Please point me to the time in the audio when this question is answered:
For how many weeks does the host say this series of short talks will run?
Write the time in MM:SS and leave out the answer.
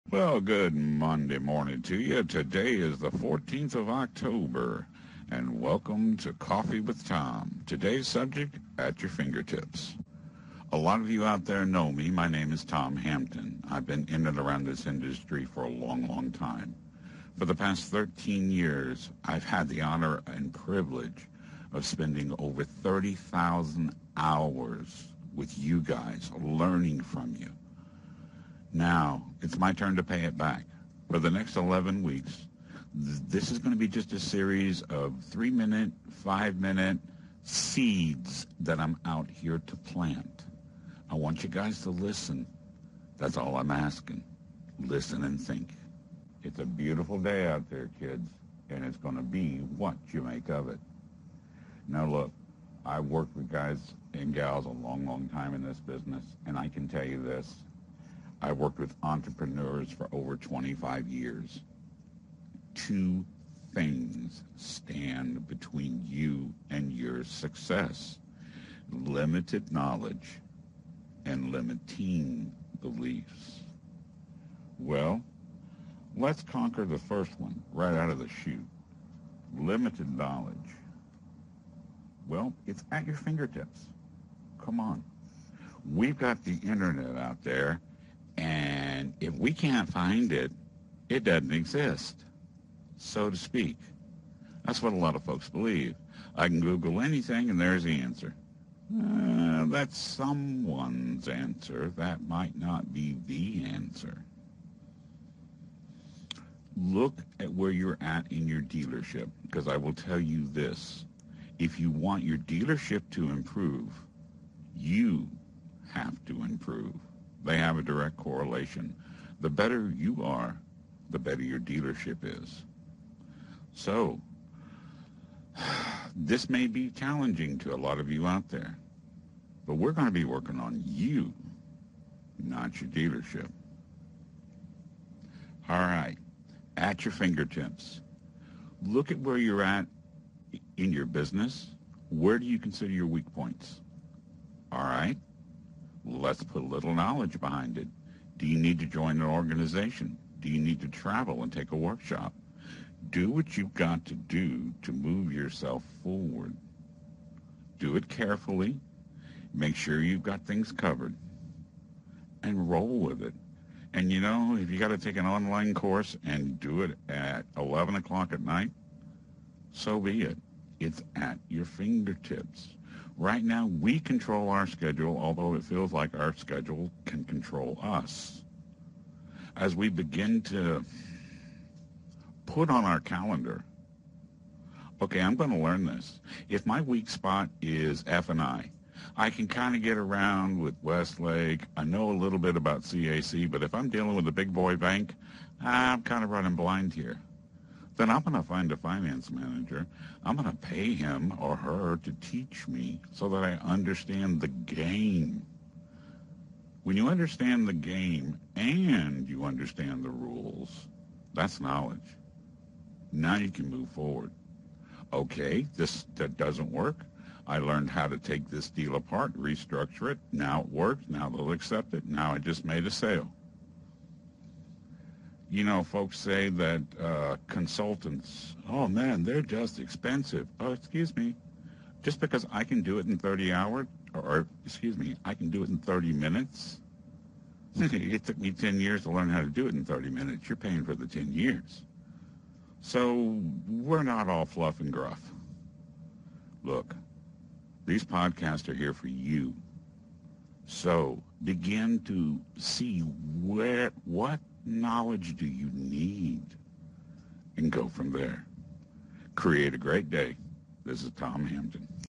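00:31.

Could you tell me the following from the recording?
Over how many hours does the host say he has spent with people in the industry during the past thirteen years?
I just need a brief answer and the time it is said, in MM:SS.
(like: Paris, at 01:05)
30,000, at 00:22.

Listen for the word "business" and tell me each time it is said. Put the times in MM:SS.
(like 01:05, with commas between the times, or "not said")
00:55, 02:21.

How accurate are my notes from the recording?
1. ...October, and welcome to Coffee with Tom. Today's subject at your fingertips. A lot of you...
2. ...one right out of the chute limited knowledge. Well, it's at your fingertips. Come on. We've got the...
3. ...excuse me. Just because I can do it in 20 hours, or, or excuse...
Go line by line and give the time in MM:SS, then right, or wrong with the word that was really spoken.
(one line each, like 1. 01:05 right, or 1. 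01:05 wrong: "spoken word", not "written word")
1. 00:03 right
2. 01:17 right
3. 03:50 wrong: "30", not "20".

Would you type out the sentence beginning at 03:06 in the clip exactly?
If my weak spot is F&I, I can kind of get around with Westlake.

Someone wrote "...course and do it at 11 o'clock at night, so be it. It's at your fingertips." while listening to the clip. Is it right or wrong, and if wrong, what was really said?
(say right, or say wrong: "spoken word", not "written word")
right.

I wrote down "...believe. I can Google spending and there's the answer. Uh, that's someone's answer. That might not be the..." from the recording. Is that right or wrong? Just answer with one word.
wrong.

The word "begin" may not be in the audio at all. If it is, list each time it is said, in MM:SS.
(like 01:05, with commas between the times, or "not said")
02:59, 04:11.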